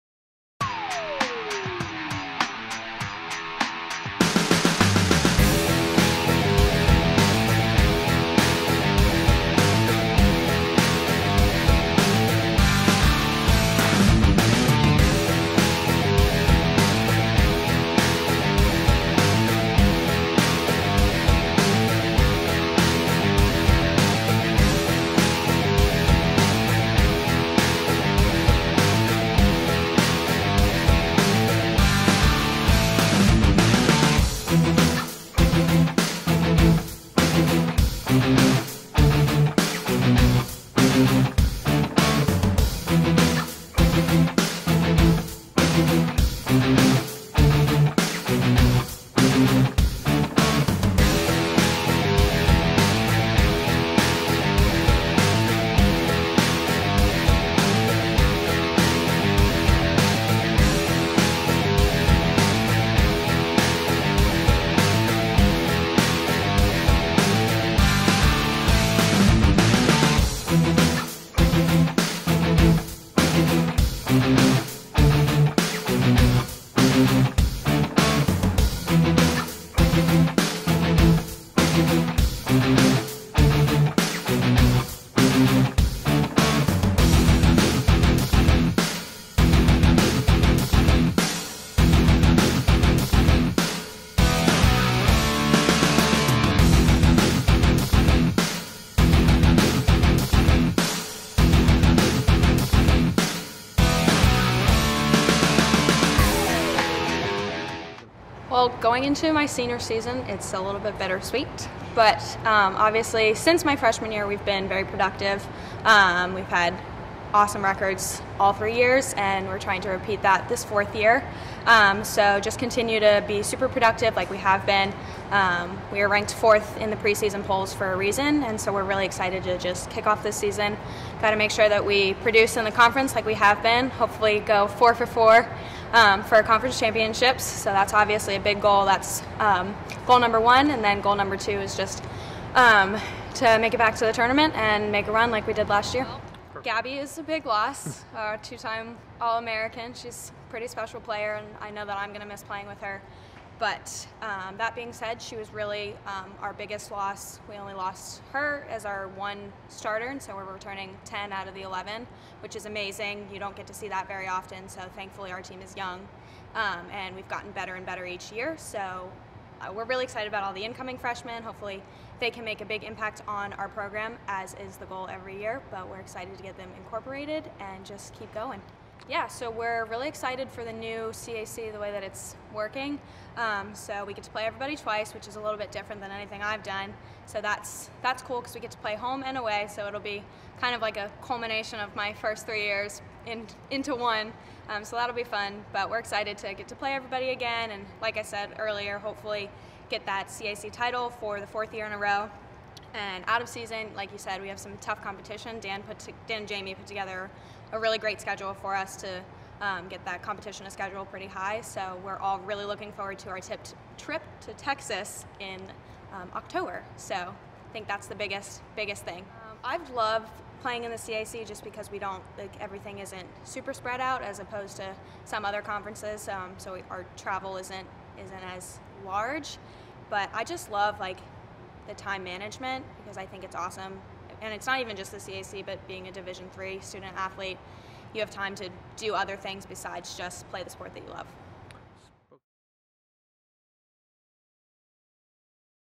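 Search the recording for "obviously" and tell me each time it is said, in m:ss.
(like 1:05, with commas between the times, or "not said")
1:52, 2:17.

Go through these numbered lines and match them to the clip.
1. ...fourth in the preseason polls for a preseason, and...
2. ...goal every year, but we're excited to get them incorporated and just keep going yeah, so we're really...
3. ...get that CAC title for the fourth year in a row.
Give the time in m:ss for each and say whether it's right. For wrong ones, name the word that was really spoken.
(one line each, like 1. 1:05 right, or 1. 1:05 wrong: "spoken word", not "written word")
1. 2:06 wrong: "reason", not "preseason"
2. 2:54 right
3. 3:19 right.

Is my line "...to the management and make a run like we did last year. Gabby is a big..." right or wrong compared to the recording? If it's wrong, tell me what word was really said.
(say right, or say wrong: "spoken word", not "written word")
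wrong: "tournament", not "management".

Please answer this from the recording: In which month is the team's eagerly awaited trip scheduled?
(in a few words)
October.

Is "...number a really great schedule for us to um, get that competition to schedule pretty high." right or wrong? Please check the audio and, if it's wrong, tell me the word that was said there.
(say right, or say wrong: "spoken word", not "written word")
wrong: "together", not "number".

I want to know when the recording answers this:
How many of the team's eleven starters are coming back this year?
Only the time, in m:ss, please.
2:41.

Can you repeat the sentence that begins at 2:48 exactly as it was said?
So uh, we're really excited about all the incoming freshmen.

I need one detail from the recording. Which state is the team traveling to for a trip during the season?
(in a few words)
Texas.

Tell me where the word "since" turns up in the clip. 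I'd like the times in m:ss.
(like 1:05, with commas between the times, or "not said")
1:53.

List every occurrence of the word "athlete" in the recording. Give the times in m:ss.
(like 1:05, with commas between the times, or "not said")
3:57.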